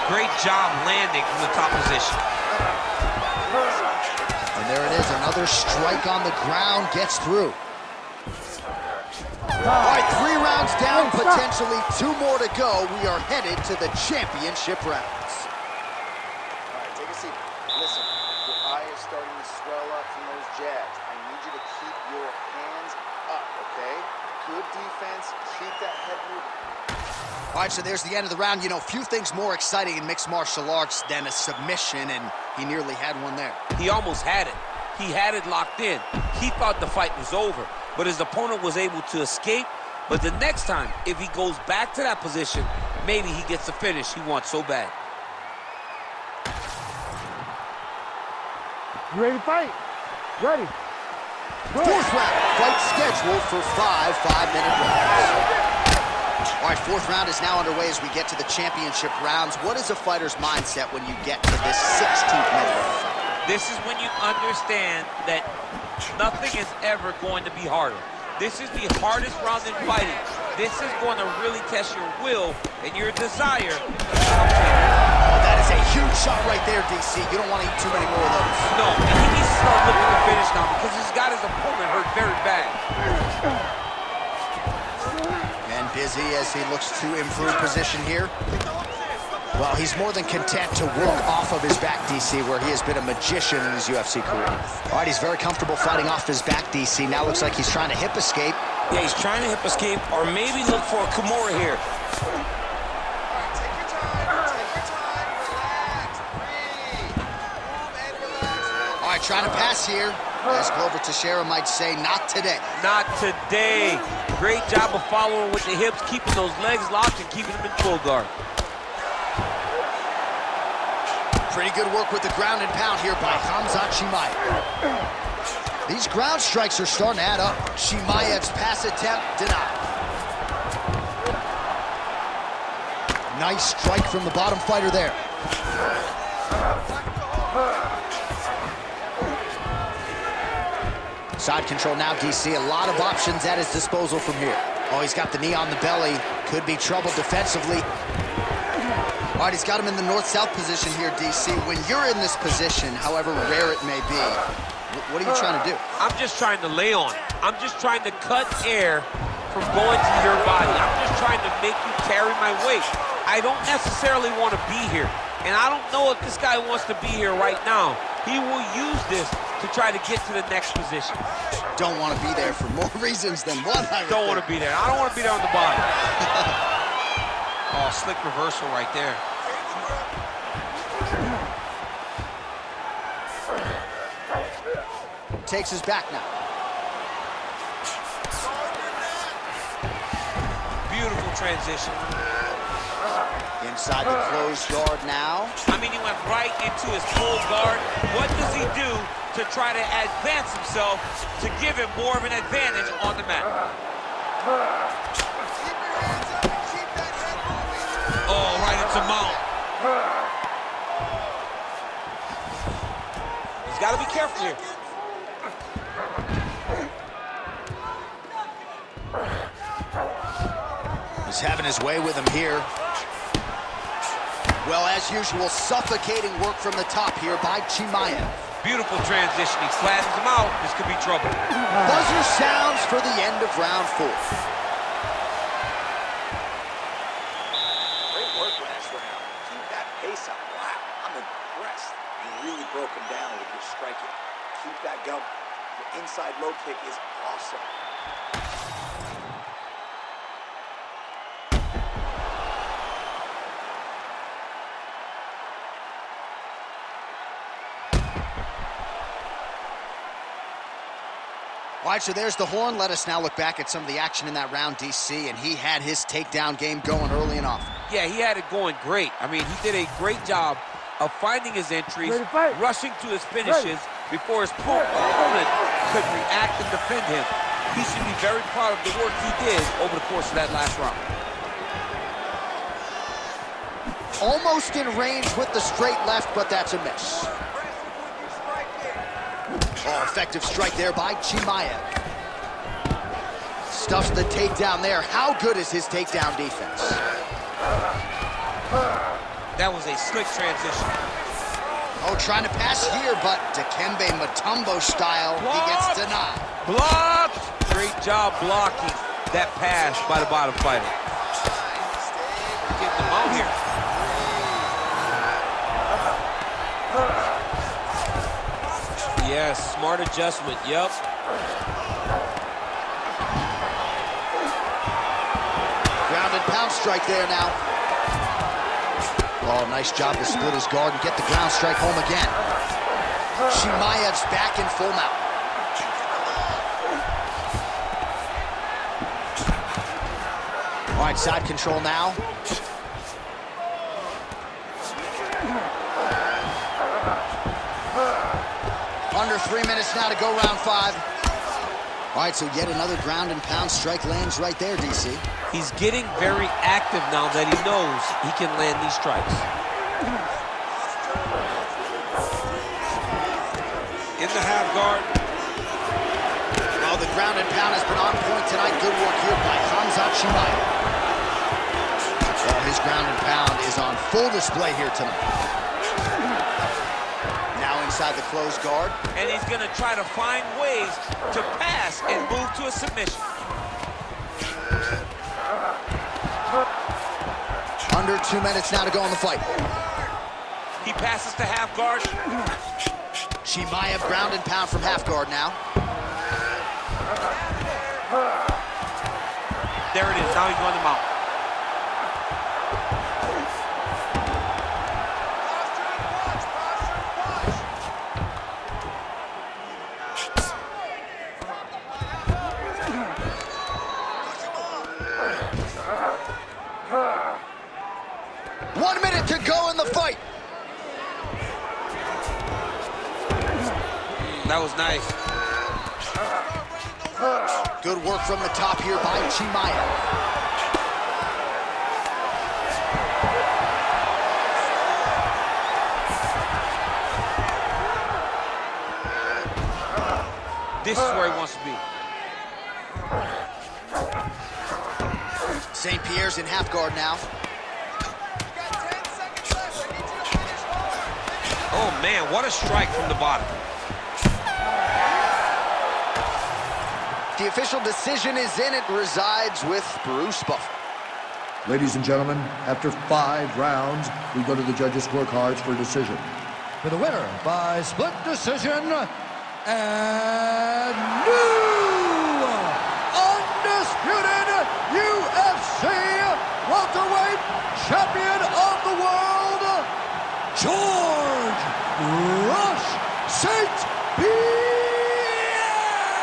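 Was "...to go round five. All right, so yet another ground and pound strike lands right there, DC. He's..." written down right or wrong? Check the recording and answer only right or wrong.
right.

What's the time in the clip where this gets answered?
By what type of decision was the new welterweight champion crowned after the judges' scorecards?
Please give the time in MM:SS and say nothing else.
07:47.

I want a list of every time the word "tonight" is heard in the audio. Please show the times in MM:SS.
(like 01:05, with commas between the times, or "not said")
06:08, 06:14.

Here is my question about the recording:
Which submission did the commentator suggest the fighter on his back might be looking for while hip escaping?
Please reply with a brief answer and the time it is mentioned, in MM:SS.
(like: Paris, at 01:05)
Kimura, at 01:41.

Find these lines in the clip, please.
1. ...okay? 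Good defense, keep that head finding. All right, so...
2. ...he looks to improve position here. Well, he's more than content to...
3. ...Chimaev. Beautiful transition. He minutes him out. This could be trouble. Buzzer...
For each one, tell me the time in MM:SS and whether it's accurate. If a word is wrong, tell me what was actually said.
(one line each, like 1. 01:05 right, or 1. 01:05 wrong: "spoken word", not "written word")
1. 00:23 wrong: "moving", not "finding"
2. 01:26 right
3. 03:47 wrong: "slashes", not "minutes".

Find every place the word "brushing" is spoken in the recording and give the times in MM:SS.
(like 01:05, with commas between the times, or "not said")
not said.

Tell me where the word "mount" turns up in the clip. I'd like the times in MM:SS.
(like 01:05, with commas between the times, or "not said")
03:29, 05:34, 06:40.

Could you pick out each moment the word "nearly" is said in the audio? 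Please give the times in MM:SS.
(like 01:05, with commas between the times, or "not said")
00:32.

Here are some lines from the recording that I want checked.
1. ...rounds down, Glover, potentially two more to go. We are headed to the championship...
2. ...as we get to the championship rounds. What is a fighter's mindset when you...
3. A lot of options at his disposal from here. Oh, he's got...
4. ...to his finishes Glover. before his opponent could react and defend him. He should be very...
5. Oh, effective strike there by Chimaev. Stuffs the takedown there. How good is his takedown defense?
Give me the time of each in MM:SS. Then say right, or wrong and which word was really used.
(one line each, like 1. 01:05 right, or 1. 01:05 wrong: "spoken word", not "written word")
1. 00:10 wrong: "Wait", not "Glover"
2. 00:57 right
3. 02:22 right
4. 04:32 wrong: "Ready", not "Glover"
5. 04:49 right.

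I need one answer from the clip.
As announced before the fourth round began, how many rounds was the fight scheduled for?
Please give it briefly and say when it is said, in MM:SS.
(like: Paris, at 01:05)
5, at 00:53.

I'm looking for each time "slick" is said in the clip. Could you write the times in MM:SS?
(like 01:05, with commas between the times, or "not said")
02:58, 04:59.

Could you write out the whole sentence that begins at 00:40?
But the next time, if he goes back to that position, maybe he gets the finish he wants so bad.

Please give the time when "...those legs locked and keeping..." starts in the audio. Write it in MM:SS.
01:56.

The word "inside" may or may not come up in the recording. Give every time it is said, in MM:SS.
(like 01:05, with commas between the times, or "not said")
03:13, 06:17.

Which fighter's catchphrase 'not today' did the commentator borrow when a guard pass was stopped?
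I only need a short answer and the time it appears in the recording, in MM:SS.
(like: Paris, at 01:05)
Glover Teixeira, at 01:50.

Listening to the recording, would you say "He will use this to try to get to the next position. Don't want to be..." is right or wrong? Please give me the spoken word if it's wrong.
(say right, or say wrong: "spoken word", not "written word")
right.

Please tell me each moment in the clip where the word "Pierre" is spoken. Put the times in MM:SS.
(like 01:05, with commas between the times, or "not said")
07:26, 08:04.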